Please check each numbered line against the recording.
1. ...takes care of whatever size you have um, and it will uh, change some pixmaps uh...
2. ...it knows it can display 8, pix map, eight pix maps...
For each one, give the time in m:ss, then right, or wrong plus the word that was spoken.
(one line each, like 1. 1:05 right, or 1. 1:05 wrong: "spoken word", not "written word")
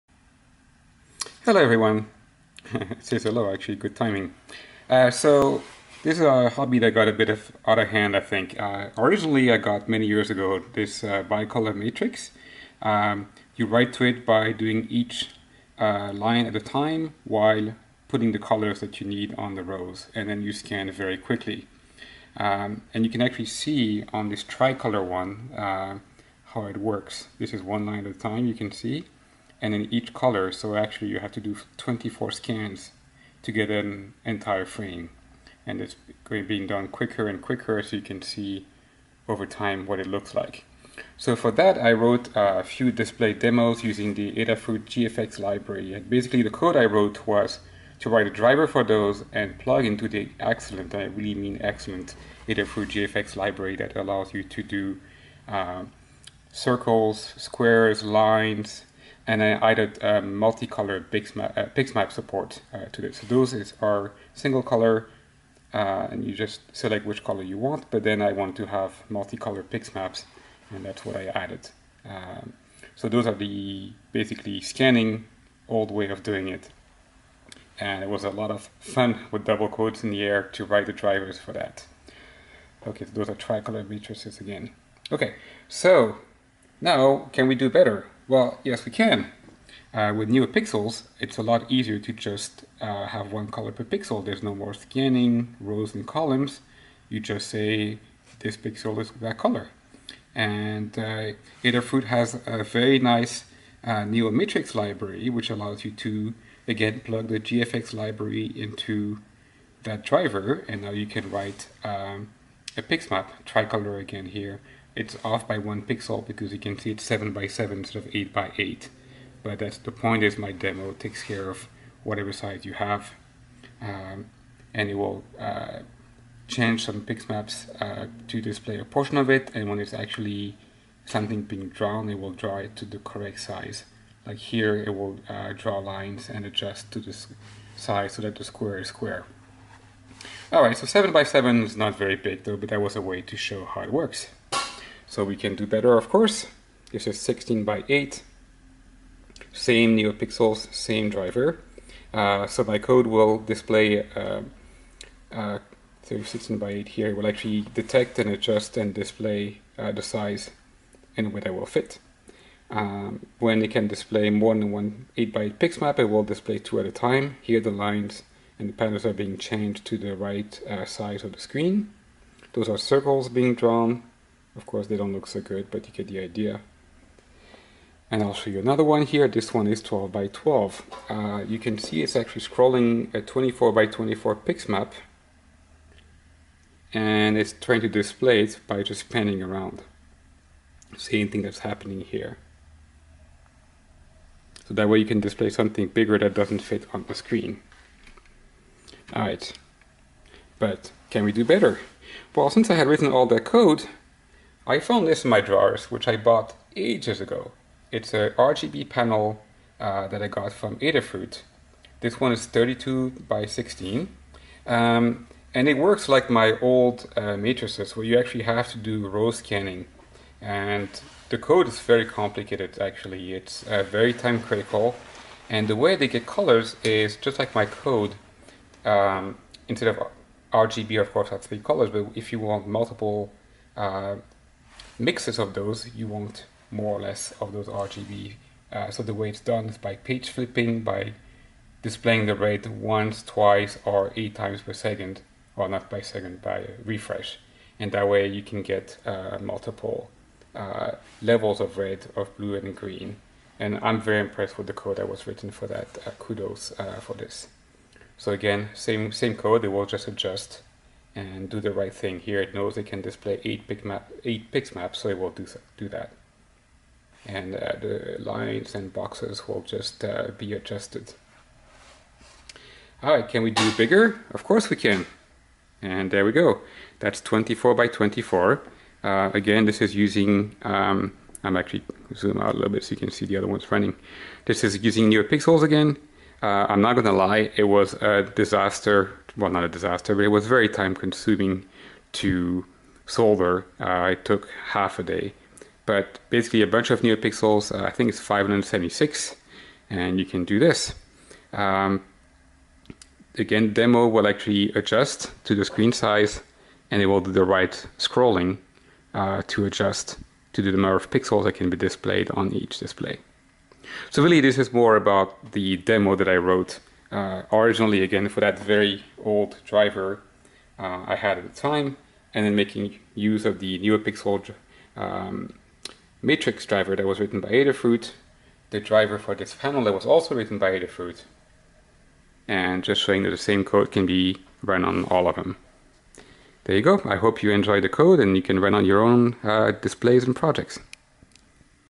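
1. 2:00 right
2. 4:22 right.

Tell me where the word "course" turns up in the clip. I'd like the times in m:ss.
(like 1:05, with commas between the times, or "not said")
2:26, 2:54, 3:51, 4:34.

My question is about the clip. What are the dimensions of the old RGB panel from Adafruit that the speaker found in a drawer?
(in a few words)
32 by 16.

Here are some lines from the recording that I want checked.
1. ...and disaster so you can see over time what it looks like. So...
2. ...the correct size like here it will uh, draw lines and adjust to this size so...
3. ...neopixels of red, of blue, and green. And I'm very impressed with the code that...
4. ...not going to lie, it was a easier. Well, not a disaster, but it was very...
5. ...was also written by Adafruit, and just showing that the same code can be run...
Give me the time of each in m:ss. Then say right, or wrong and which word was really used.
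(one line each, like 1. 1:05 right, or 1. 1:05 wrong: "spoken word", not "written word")
1. 0:37 wrong: "quicker", not "disaster"
2. 2:12 right
3. 4:11 wrong: "levels", not "neopixels"
4. 4:46 wrong: "disaster", not "easier"
5. 5:29 right.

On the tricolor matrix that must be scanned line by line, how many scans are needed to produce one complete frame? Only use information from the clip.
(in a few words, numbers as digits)
24.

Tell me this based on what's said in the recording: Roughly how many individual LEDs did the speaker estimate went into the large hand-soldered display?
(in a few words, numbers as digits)
576.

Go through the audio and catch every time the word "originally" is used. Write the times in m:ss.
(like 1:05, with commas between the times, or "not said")
0:08, 5:17.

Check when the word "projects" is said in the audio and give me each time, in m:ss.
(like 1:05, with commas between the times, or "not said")
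5:40.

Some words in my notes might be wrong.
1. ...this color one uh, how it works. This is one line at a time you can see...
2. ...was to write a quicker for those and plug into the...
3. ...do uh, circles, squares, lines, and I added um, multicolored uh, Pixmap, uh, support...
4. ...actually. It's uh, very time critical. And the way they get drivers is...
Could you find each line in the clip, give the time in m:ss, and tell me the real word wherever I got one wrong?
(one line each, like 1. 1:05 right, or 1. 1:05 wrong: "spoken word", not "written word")
1. 0:24 wrong: "tricolor", not "color"
2. 0:47 wrong: "driver", not "quicker"
3. 0:54 right
4. 3:42 wrong: "colors", not "drivers".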